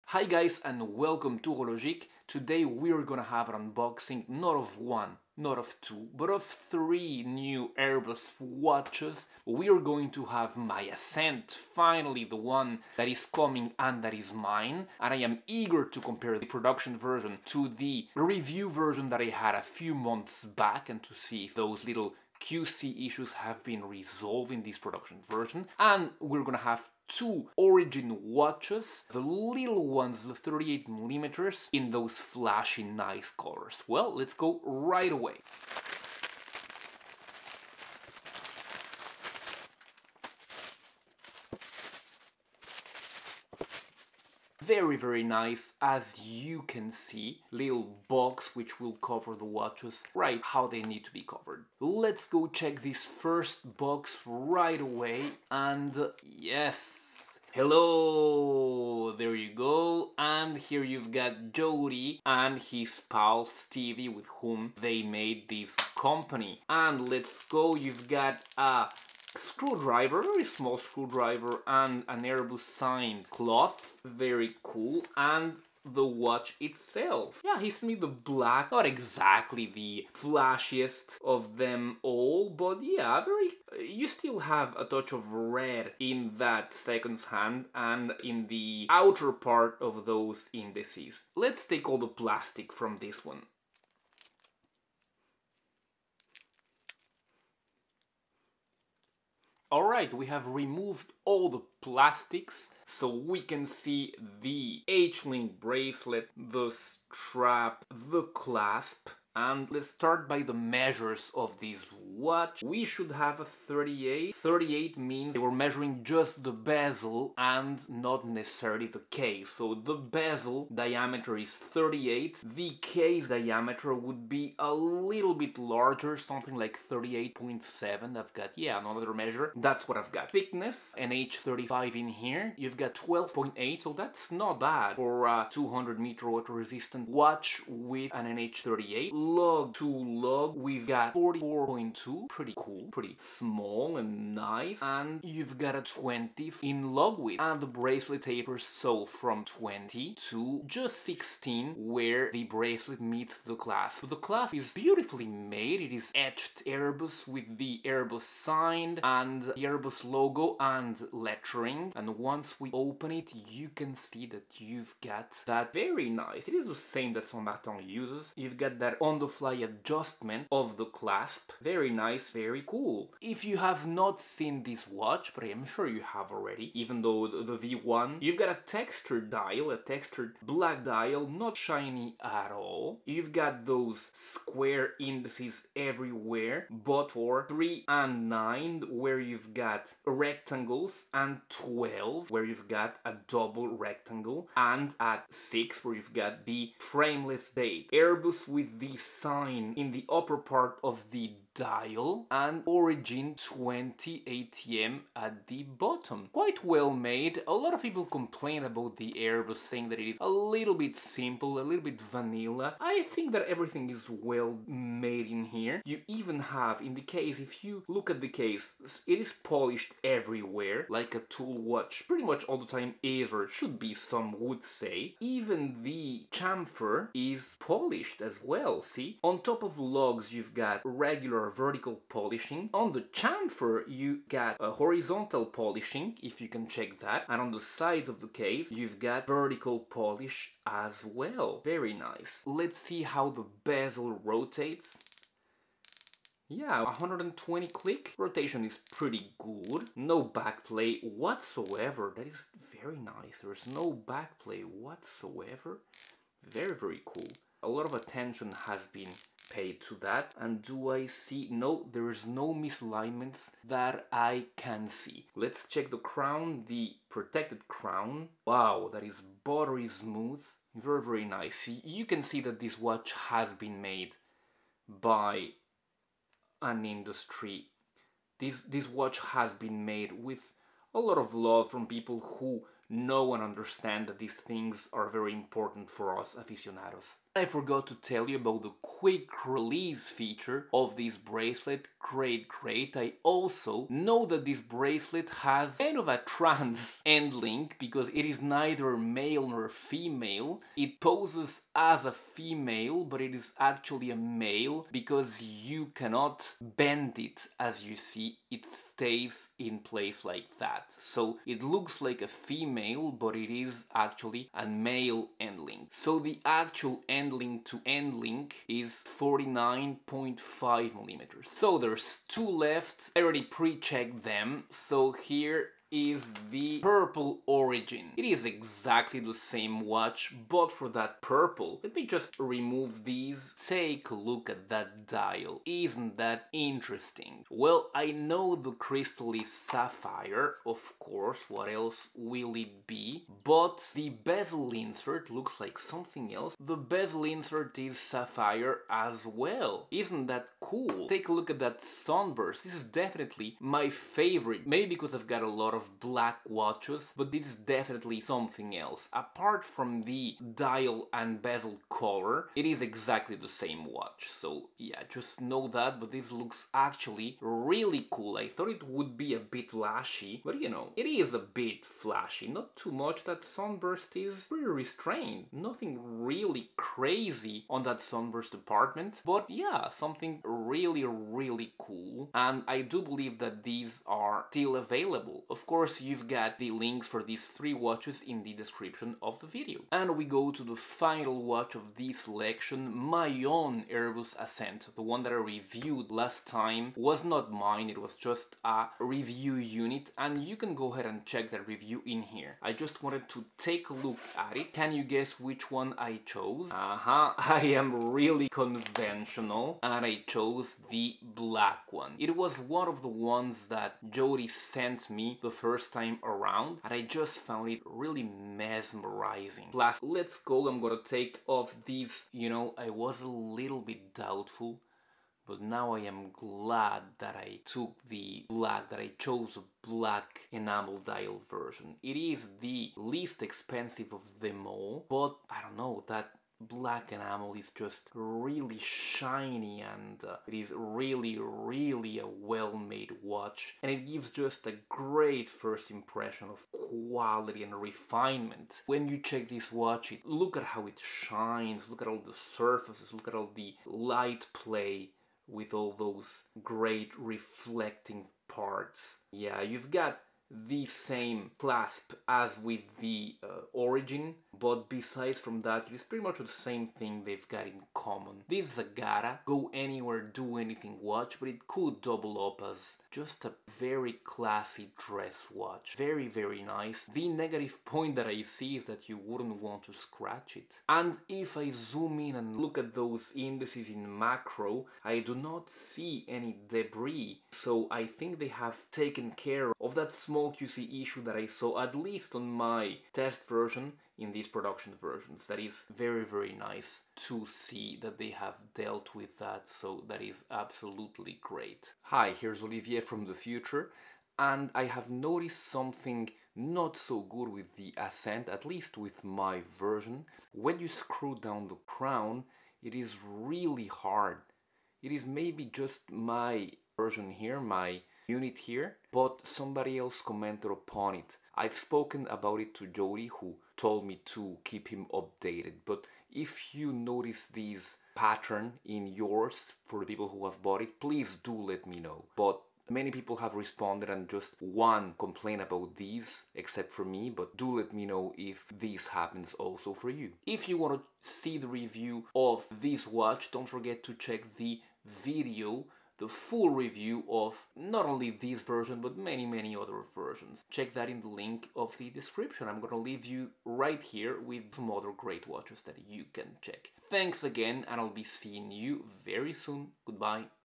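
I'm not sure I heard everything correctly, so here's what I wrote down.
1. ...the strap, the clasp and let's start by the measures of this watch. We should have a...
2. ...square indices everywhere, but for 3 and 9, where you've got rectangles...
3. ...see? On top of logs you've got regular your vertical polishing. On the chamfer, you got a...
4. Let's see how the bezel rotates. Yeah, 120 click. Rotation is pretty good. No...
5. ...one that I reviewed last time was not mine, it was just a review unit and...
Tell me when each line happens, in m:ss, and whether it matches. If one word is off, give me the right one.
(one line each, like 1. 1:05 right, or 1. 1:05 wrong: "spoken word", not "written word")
1. 1:46 right
2. 3:04 right
3. 3:48 right
4. 4:02 right
5. 6:35 right.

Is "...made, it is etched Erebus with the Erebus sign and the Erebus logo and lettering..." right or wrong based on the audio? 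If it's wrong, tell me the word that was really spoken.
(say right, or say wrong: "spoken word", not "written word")
right.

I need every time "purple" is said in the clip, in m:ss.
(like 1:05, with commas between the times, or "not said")
5:26, 5:31.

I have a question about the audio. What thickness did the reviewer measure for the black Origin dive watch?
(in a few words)
12.8.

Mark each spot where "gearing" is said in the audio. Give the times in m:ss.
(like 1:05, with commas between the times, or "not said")
not said.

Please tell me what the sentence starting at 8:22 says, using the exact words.
Hi, here's Olivier from the future, and I have noticed something not so good with the Ascent, at least with my version.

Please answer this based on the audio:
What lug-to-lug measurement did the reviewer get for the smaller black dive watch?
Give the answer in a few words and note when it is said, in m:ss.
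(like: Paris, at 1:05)
44.2, at 2:21.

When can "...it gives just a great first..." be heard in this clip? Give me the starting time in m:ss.
7:23.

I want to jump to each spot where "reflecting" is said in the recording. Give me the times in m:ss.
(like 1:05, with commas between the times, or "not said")
7:37.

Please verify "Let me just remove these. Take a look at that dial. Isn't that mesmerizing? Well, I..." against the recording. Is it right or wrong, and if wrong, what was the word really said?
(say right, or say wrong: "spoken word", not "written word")
wrong: "interesting", not "mesmerizing".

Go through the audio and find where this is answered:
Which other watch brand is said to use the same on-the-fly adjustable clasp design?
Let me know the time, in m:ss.
2:47.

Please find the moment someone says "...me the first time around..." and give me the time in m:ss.
6:55.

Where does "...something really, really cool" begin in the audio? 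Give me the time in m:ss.
6:19.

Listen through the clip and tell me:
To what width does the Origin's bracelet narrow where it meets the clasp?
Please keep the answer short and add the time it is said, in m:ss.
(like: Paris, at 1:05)
16, at 2:31.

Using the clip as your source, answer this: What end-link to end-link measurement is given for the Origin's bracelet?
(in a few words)
49.5 millimeters.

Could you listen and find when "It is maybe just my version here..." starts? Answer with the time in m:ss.
8:35.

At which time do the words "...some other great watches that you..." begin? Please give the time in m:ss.
9:14.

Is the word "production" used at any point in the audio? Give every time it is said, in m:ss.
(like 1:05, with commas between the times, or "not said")
0:16, 0:24, 8:14.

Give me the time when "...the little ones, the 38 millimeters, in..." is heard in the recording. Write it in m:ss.
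0:29.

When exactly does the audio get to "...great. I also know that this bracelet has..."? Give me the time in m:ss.
4:52.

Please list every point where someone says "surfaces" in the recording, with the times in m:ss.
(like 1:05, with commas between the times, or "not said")
7:32.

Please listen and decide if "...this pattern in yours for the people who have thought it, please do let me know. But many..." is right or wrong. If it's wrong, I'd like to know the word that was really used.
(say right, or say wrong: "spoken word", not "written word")
wrong: "bought", not "thought".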